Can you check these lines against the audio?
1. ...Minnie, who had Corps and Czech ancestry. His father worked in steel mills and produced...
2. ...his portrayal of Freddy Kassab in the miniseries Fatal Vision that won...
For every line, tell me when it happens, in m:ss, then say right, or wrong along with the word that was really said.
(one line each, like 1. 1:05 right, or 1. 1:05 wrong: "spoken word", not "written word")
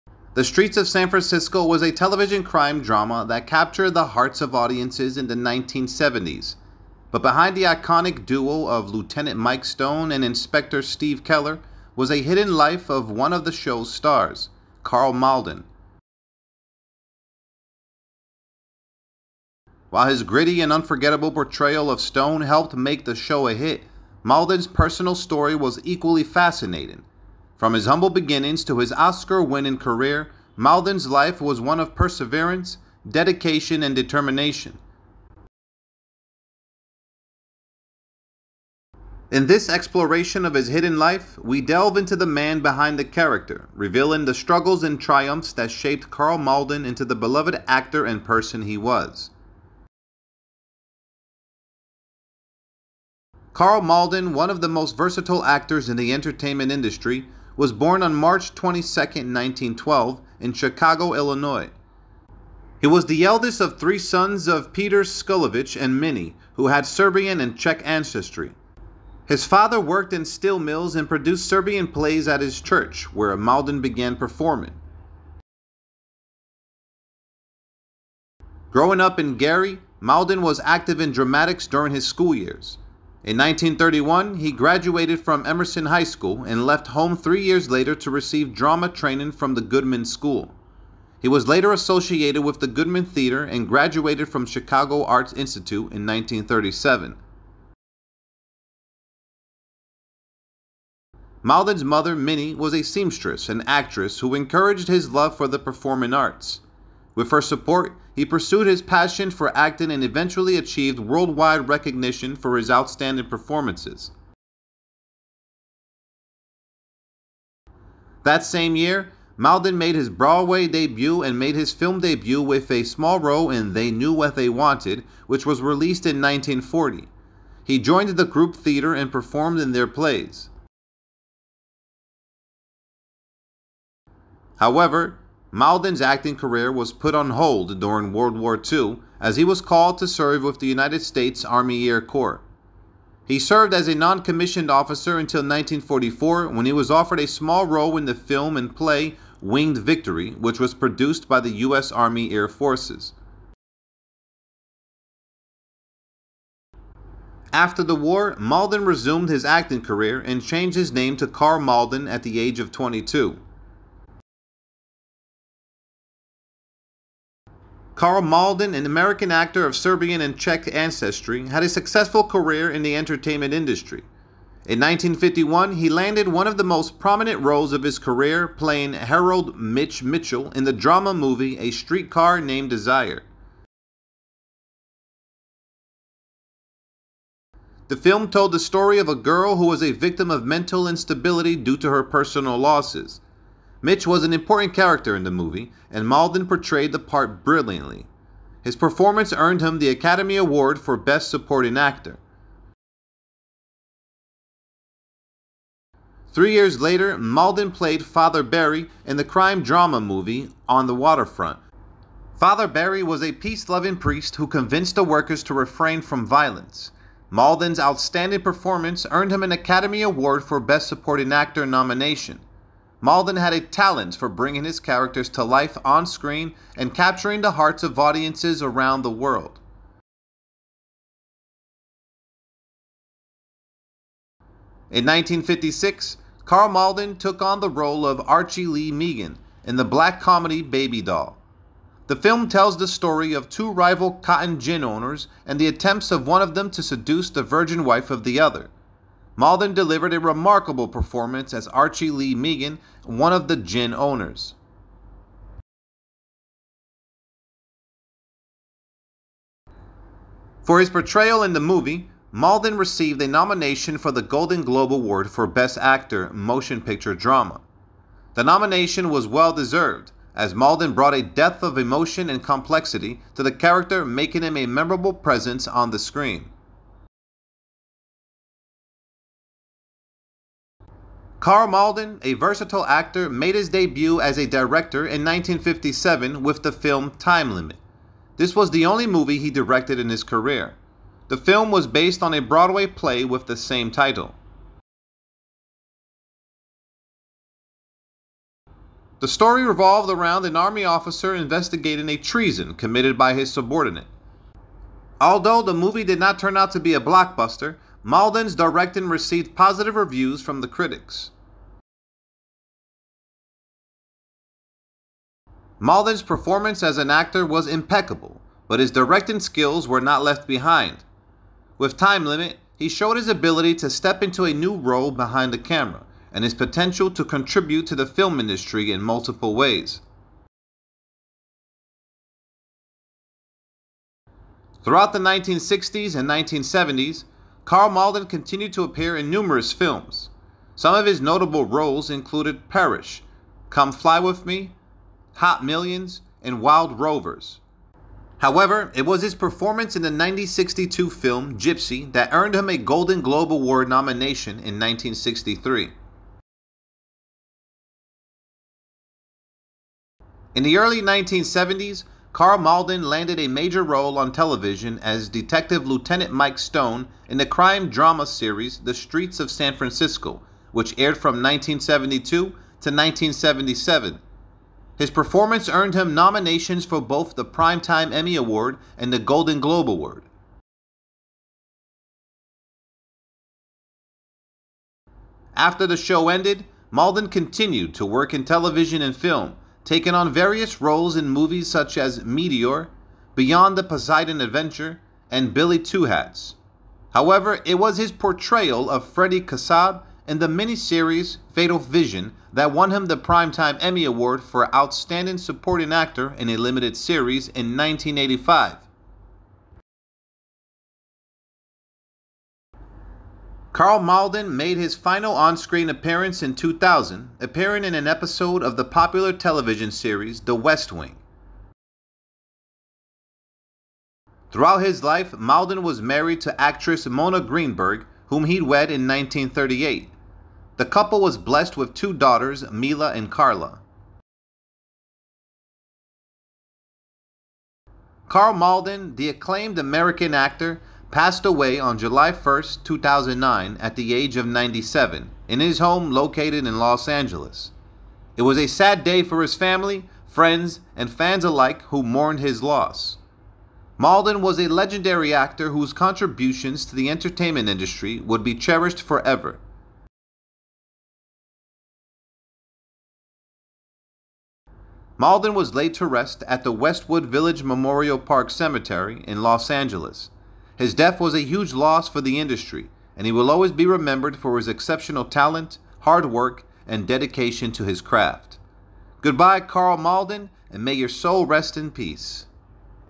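1. 1:05 wrong: "Serbian", not "Corps"
2. 6:37 right.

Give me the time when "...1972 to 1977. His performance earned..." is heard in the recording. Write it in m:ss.
6:11.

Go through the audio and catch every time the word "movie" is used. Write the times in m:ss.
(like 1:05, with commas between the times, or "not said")
3:01, 3:15, 3:29, 4:21, 4:49, 5:05, 6:31.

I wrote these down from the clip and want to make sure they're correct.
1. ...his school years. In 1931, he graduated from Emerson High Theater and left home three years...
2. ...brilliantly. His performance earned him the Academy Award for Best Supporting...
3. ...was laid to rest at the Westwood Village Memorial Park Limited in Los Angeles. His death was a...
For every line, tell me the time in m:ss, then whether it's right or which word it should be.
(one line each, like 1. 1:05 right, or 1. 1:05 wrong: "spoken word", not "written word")
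1. 1:21 wrong: "School", not "Theater"
2. 3:17 right
3. 7:45 wrong: "Cemetery", not "Limited".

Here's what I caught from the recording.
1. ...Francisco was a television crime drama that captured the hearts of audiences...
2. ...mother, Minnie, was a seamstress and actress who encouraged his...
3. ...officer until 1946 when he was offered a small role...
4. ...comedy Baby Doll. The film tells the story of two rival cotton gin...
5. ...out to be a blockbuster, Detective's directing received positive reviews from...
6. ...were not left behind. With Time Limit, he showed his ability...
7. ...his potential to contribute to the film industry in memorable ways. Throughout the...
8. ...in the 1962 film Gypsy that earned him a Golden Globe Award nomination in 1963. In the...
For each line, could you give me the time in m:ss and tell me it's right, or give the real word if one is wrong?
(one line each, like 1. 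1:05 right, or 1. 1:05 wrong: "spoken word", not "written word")
1. 0:01 right
2. 1:41 right
3. 2:24 wrong: "1944", not "1946"
4. 4:00 right
5. 5:06 wrong: "Malden", not "Detective"
6. 5:19 right
7. 5:26 wrong: "multiple", not "memorable"
8. 5:49 right.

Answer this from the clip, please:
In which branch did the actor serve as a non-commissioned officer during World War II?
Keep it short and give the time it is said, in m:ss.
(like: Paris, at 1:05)
United States Army Air Corps, at 2:20.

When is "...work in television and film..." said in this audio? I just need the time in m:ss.
6:28.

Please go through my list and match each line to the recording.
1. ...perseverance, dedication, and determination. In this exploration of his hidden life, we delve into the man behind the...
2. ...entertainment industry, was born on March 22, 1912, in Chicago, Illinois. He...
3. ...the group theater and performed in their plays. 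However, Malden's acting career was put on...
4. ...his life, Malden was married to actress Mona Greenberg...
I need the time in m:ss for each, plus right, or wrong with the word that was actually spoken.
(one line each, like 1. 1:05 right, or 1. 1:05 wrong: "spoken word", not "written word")
1. 0:31 right
2. 0:56 right
3. 2:08 right
4. 7:04 right.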